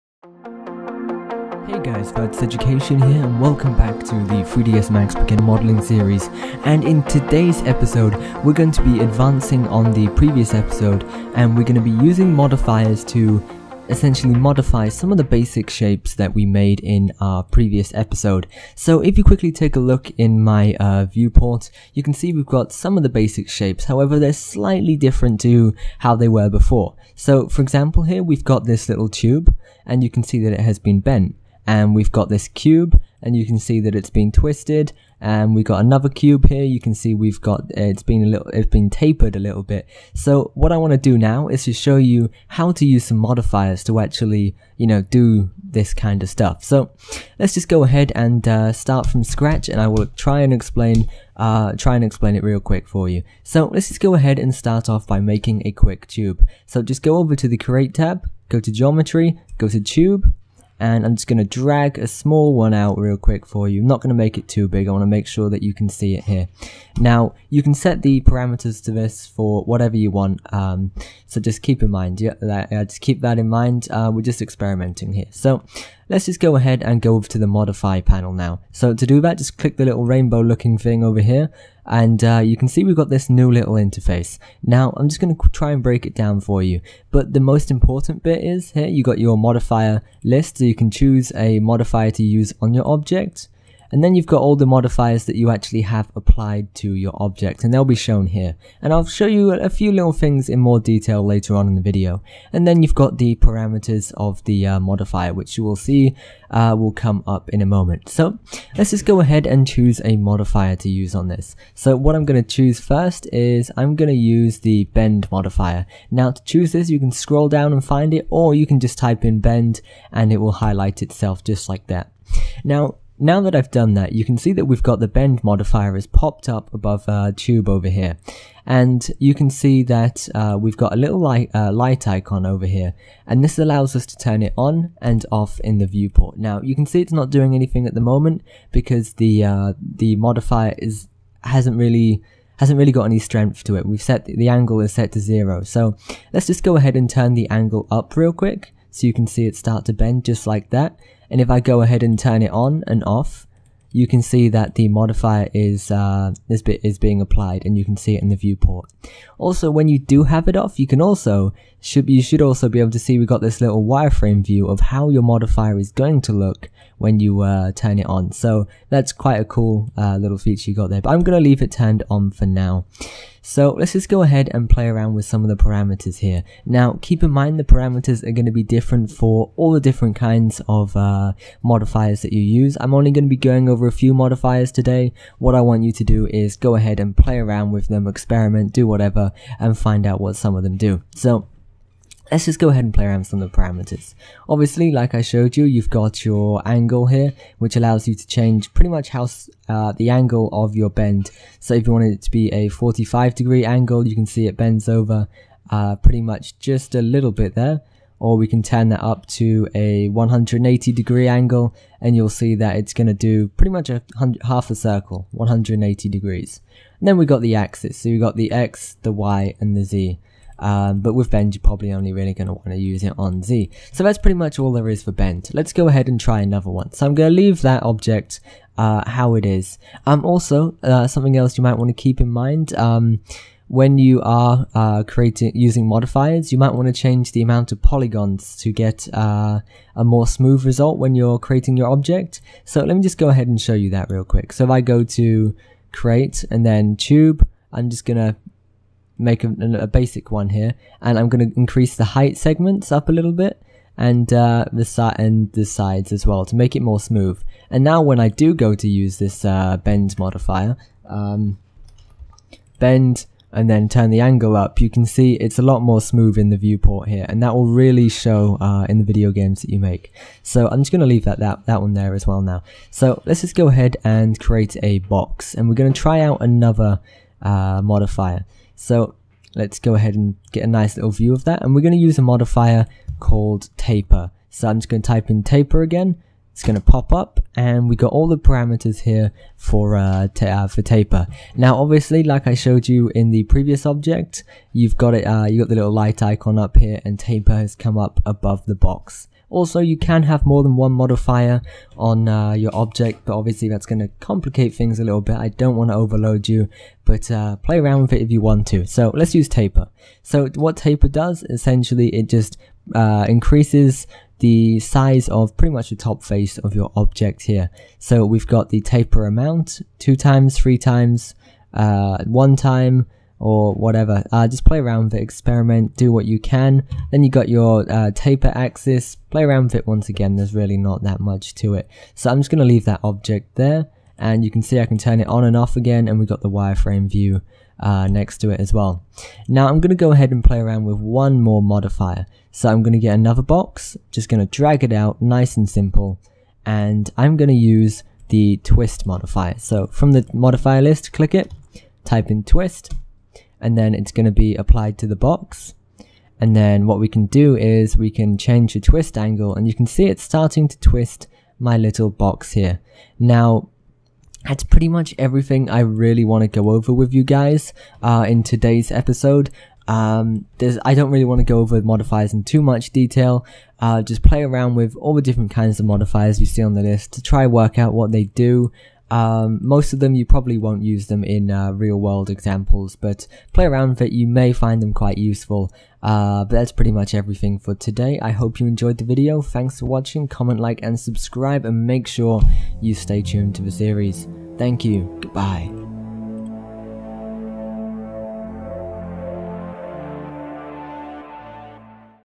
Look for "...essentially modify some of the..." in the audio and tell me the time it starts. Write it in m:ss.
0:13.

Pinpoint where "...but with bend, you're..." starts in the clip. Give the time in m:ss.
3:40.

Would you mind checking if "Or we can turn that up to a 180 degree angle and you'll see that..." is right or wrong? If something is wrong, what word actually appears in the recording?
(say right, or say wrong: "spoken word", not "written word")
right.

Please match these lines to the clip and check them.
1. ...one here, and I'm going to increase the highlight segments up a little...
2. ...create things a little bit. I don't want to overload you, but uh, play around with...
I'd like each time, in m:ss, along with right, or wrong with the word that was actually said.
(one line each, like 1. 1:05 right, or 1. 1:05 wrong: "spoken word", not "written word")
1. 4:10 wrong: "height", not "highlight"
2. 5:04 wrong: "complicate", not "create".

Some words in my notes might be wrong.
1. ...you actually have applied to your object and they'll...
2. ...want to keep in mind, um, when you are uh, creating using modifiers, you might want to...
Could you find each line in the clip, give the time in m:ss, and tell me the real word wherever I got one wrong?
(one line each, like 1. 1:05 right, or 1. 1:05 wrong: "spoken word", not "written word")
1. 1:35 right
2. 3:51 right.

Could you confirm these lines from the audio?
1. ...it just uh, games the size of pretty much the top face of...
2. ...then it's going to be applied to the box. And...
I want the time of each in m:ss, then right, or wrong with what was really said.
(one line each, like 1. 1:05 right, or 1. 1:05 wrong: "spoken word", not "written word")
1. 5:12 wrong: "increases", not "games"
2. 5:53 right.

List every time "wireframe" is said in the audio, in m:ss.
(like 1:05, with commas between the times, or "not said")
2:43, 5:36.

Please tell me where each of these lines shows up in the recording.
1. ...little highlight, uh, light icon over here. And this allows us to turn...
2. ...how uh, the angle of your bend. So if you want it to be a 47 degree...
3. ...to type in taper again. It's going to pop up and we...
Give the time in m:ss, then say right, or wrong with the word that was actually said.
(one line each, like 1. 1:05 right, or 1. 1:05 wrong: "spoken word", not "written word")
1. 2:10 wrong: "light", not "highlight"
2. 3:19 wrong: "45", not "47"
3. 4:45 right.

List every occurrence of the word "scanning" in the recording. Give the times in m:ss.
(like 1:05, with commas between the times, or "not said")
not said.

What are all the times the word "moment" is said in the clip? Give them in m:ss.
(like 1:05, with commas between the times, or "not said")
1:47, 2:18.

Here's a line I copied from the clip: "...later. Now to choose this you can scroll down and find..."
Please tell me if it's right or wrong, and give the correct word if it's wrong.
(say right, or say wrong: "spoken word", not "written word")
wrong: "modifier", not "later".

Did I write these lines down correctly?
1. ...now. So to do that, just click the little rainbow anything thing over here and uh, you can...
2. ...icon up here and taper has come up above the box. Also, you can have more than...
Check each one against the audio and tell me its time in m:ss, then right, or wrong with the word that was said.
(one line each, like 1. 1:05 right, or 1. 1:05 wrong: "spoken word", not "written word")
1. 1:18 wrong: "looking", not "anything"
2. 4:56 right.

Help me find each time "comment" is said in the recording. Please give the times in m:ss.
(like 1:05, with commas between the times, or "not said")
6:30.